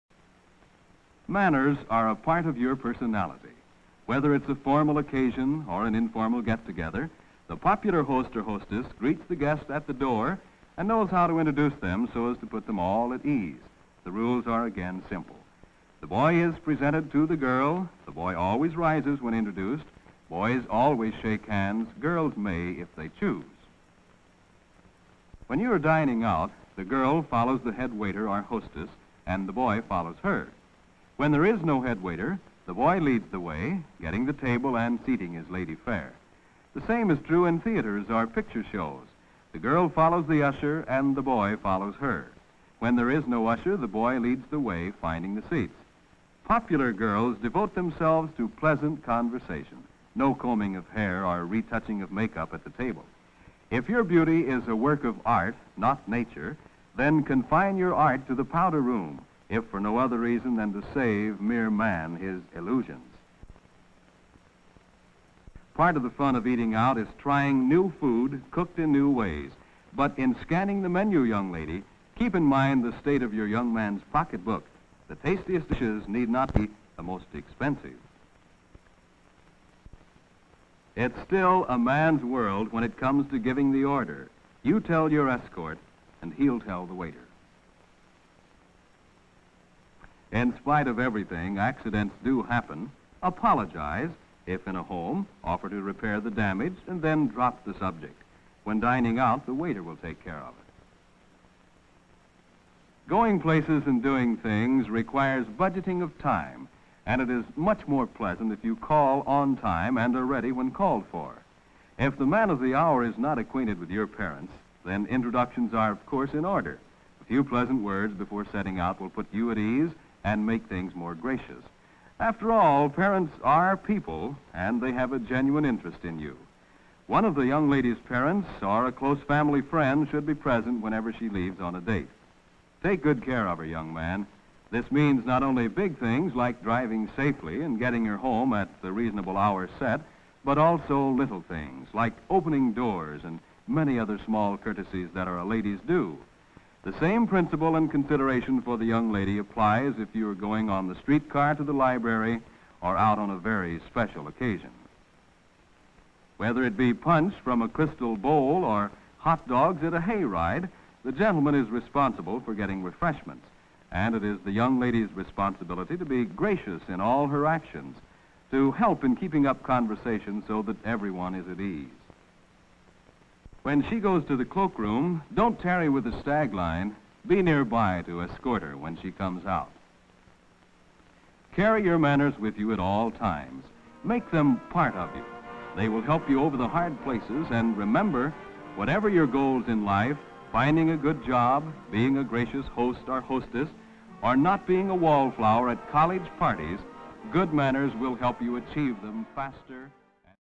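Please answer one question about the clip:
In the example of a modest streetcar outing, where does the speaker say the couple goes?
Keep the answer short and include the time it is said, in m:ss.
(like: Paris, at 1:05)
The library, at 2:31.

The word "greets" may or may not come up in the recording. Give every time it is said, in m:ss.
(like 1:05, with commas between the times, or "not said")
0:08.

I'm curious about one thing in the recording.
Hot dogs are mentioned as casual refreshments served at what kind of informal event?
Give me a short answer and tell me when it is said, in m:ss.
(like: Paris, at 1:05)
A hayride, at 2:39.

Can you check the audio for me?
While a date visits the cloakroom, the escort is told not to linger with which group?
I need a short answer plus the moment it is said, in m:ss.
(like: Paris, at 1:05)
The stag line, at 2:56.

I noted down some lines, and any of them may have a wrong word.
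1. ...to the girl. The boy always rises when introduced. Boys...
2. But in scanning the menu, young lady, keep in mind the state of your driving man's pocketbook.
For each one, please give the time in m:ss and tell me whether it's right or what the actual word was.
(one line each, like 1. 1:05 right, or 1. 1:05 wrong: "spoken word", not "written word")
1. 0:17 right
2. 1:09 wrong: "young", not "driving".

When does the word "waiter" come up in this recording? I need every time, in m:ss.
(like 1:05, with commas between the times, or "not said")
0:27, 0:32, 1:26, 1:39.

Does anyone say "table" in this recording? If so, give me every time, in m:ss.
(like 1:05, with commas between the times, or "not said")
0:34, 0:52.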